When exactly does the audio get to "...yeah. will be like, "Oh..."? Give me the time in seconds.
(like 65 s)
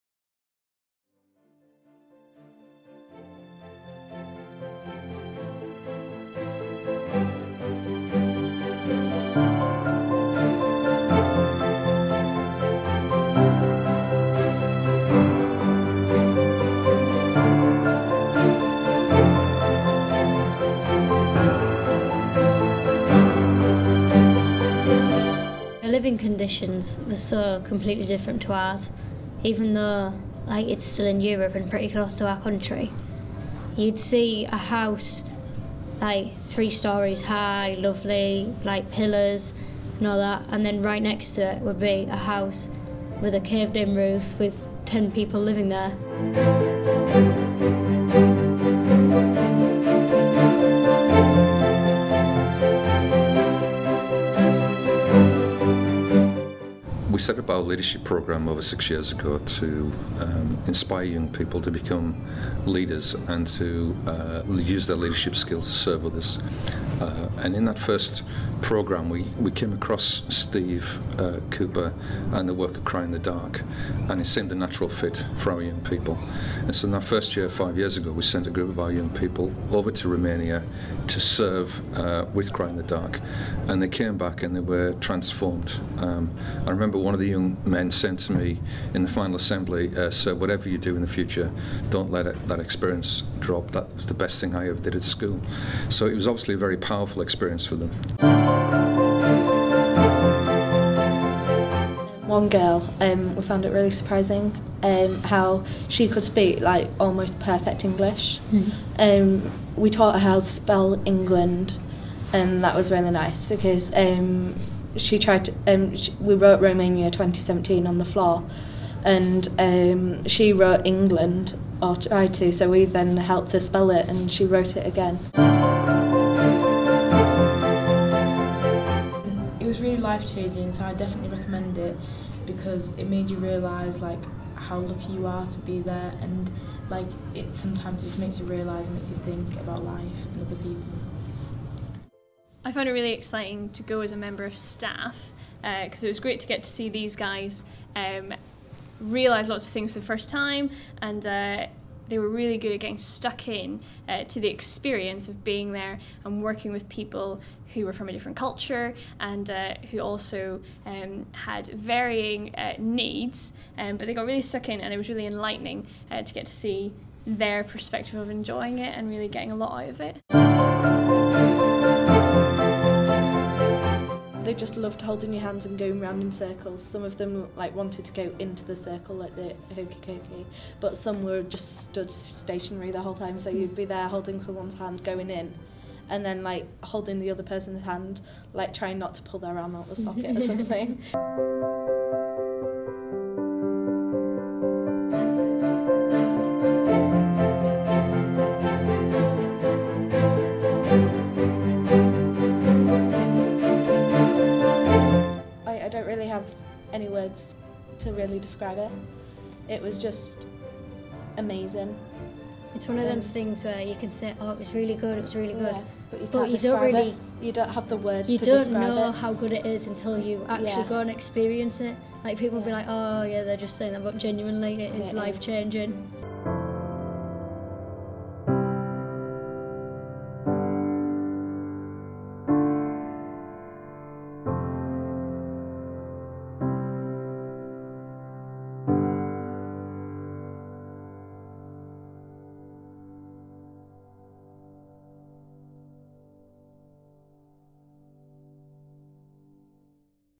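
222 s.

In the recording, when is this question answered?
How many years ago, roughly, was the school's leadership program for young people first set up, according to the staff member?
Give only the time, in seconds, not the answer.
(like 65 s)
58 s.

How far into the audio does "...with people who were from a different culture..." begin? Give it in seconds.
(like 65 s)
156 s.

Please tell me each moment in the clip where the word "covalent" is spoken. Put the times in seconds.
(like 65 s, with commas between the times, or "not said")
not said.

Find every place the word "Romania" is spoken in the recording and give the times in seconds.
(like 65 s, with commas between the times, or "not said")
80 s, 116 s.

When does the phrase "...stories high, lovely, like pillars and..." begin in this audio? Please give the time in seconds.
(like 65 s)
36 s.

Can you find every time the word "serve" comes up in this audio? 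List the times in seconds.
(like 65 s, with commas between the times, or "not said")
65 s, 81 s.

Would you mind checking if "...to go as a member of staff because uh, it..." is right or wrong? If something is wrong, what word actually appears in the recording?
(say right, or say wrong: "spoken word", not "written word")
right.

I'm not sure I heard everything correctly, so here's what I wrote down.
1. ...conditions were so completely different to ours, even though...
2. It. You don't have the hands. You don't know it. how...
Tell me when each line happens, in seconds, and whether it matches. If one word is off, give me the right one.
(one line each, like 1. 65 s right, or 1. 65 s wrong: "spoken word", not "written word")
1. 26 s right
2. 217 s wrong: "words", not "hands".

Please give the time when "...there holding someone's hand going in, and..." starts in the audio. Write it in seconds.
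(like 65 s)
183 s.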